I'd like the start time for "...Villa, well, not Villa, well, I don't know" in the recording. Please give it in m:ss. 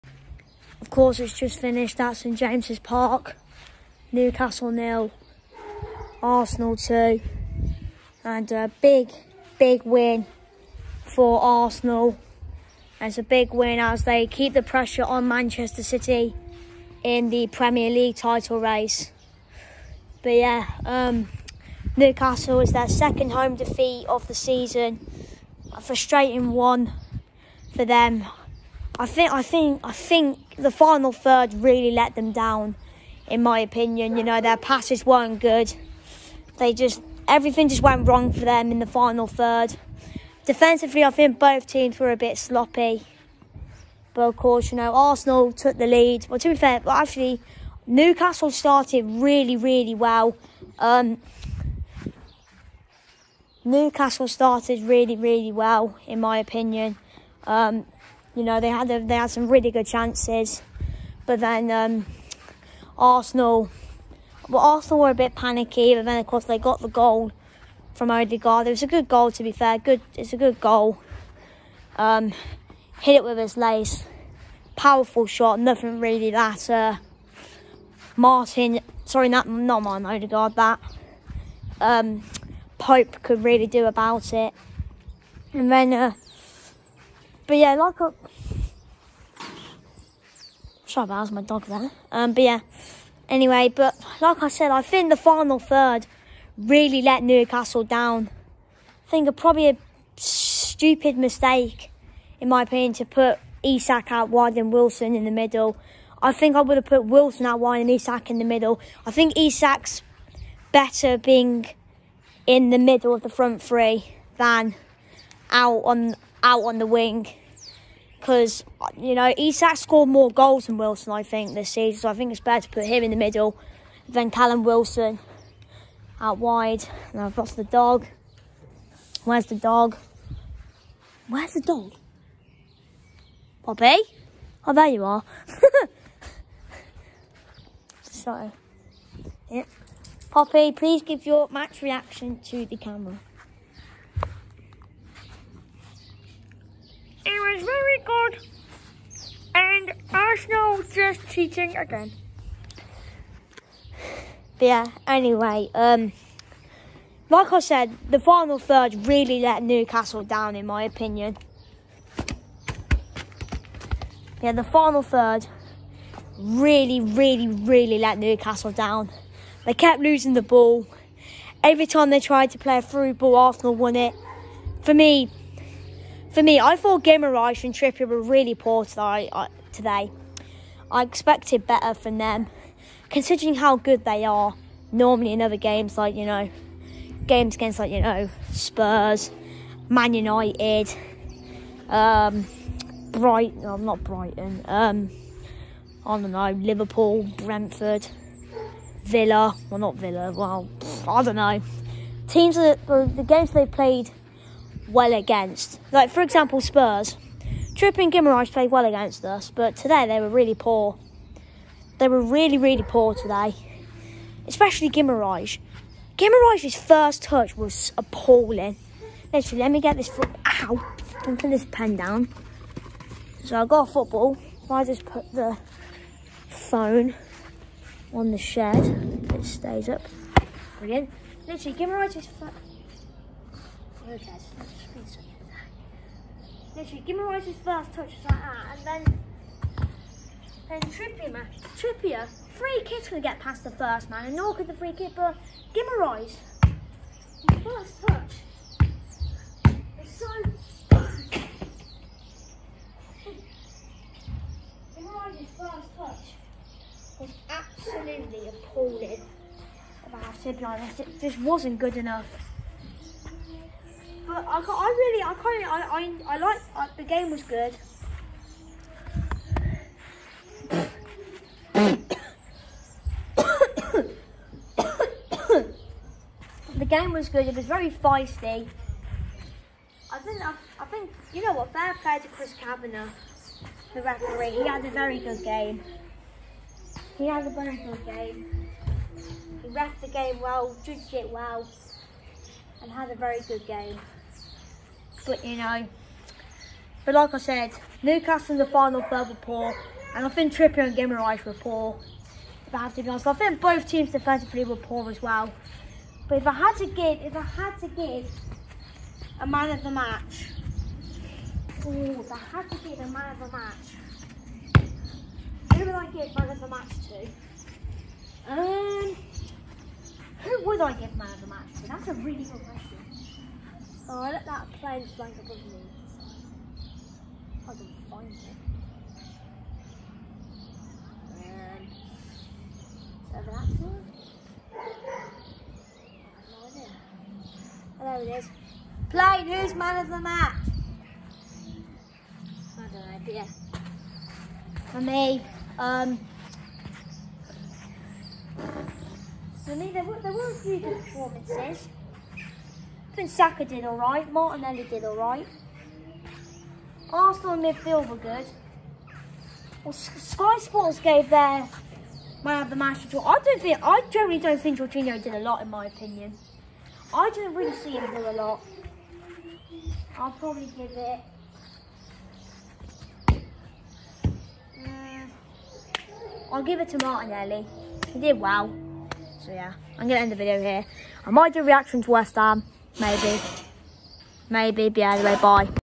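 3:19.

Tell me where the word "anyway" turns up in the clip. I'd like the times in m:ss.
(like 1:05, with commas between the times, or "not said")
1:33, 2:35.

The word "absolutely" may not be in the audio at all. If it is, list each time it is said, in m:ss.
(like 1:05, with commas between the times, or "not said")
4:17.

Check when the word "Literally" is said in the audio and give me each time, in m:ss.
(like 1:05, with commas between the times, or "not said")
3:39, 3:51, 3:56.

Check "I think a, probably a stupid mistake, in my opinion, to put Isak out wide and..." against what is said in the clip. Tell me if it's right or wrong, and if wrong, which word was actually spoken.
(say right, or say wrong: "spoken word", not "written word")
right.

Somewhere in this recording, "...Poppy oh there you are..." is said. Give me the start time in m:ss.
2:13.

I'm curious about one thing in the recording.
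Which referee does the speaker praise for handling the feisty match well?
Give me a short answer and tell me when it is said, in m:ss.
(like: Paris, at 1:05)
Chris Kavanagh, at 4:42.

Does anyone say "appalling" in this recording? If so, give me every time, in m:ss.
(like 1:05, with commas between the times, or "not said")
3:37, 4:18.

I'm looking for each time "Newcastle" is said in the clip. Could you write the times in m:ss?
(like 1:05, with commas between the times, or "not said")
0:04, 0:21, 0:47, 0:53, 1:37, 2:39, 2:48, 4:58.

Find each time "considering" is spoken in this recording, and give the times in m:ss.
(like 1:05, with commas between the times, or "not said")
3:03.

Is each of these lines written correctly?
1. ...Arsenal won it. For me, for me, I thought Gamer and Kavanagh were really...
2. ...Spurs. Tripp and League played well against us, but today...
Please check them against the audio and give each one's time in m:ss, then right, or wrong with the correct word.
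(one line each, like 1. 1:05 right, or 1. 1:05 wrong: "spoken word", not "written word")
1. 2:53 wrong: "Trippier", not "Kavanagh"
2. 3:26 wrong: "Guimarães", not "League".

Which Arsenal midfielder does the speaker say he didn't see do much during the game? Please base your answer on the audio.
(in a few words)
Jorginho.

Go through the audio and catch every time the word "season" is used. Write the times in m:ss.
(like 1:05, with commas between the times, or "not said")
0:24, 2:01.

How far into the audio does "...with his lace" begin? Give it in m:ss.
1:13.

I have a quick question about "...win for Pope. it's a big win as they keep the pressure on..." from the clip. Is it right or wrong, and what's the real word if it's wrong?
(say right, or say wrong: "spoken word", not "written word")
wrong: "Arsenal", not "Pope".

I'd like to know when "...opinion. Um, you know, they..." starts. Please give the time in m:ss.
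0:56.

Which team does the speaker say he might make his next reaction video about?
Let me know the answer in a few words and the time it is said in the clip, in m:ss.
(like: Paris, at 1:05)
West Ham, at 6:22.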